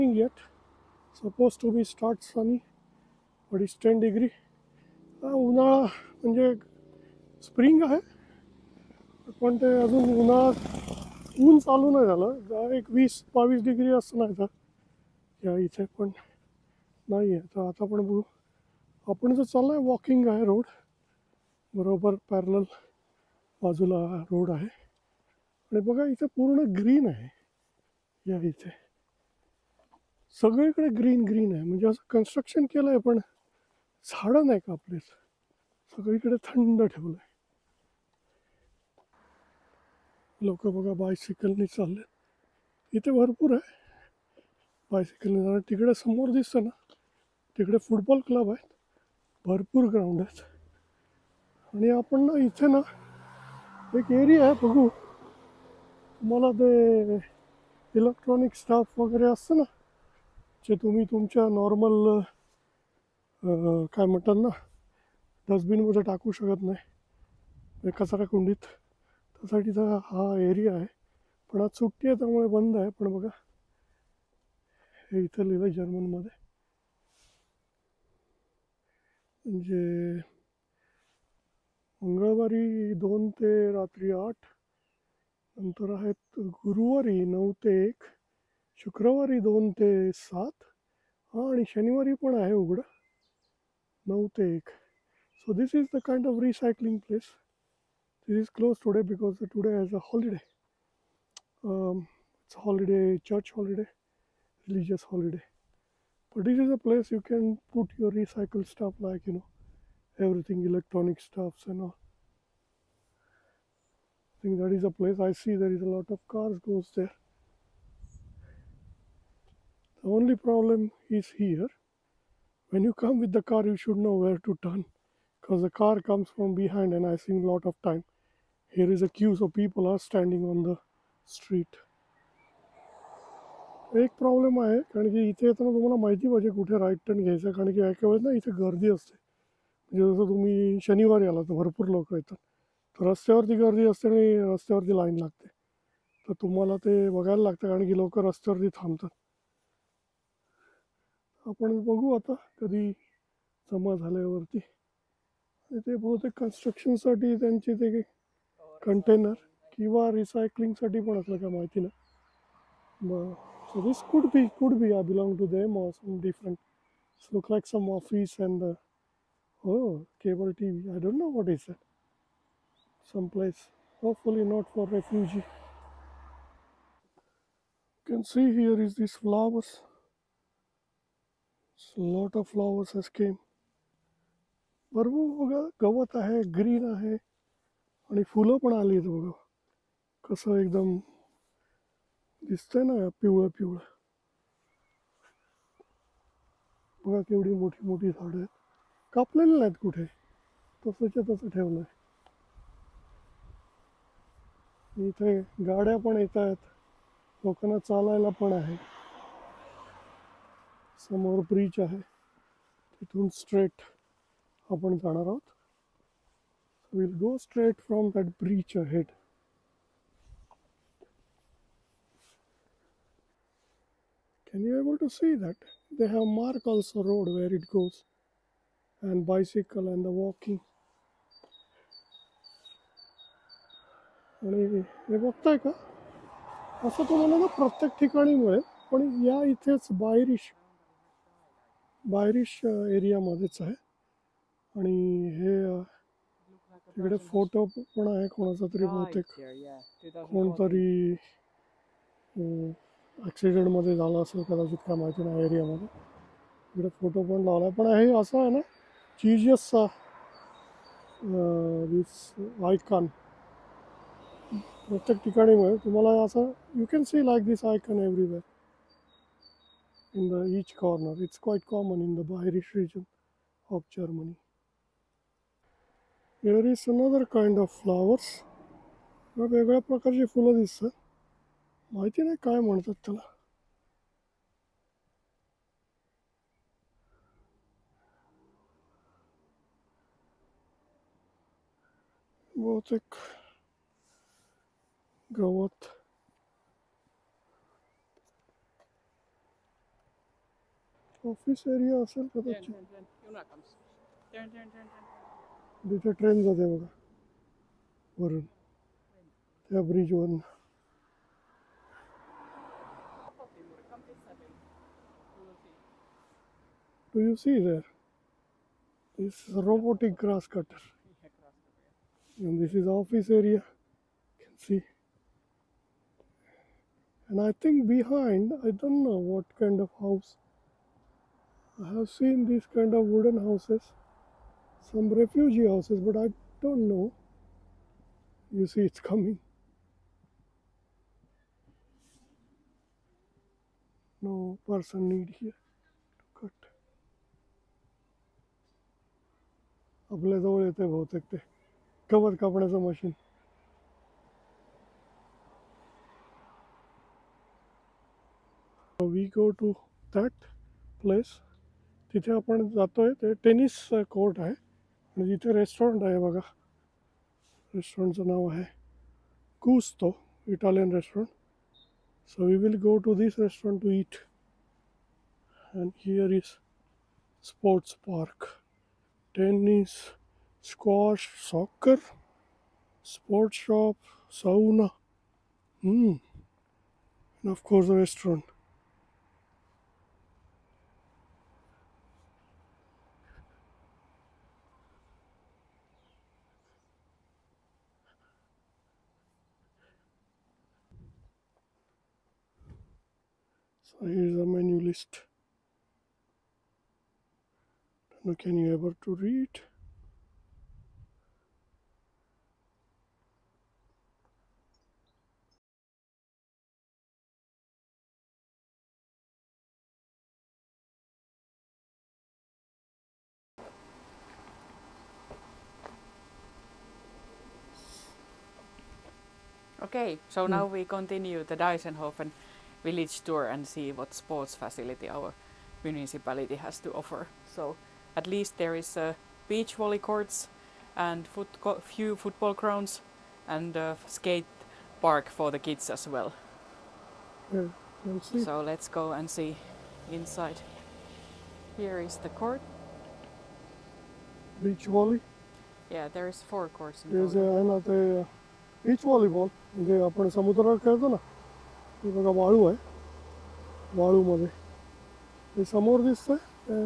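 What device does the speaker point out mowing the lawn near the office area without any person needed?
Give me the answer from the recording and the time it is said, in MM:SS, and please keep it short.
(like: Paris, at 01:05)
Robotic grass cutter, at 05:19.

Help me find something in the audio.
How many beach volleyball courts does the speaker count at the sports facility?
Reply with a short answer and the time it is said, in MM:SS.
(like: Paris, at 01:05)
4, at 07:36.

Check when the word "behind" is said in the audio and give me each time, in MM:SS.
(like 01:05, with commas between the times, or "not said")
02:06, 05:27.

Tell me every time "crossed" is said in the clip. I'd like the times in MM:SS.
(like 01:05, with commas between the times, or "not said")
not said.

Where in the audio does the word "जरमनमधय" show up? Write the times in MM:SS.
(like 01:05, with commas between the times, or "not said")
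01:15.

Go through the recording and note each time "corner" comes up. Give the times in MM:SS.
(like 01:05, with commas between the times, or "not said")
04:30.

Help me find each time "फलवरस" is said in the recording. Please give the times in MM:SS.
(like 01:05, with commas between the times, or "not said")
02:59.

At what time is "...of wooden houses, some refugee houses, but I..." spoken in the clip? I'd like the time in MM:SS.
05:32.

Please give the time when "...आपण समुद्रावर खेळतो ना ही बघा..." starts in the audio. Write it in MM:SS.
07:40.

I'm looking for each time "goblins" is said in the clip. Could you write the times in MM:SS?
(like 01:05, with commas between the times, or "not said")
not said.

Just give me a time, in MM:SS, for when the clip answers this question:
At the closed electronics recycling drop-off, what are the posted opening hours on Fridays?
01:28.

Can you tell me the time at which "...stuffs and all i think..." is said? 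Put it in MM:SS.
01:51.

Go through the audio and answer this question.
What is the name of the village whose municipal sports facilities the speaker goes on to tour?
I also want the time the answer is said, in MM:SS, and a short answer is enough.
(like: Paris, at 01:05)
Deisenhofen, at 07:11.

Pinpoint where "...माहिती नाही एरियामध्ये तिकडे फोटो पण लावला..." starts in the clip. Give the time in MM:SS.
04:14.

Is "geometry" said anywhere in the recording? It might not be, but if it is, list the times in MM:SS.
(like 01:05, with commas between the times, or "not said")
not said.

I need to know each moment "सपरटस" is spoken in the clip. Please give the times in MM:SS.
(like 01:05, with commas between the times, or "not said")
06:17, 06:23.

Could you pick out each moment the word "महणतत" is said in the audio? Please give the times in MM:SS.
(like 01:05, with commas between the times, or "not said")
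01:04, 04:42.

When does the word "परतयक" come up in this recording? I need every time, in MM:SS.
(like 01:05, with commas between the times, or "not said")
03:57, 04:24.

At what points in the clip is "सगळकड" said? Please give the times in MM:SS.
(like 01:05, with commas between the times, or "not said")
00:30, 00:35.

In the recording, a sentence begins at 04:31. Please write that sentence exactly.
It's quite common in the Bayerisch region of Germany.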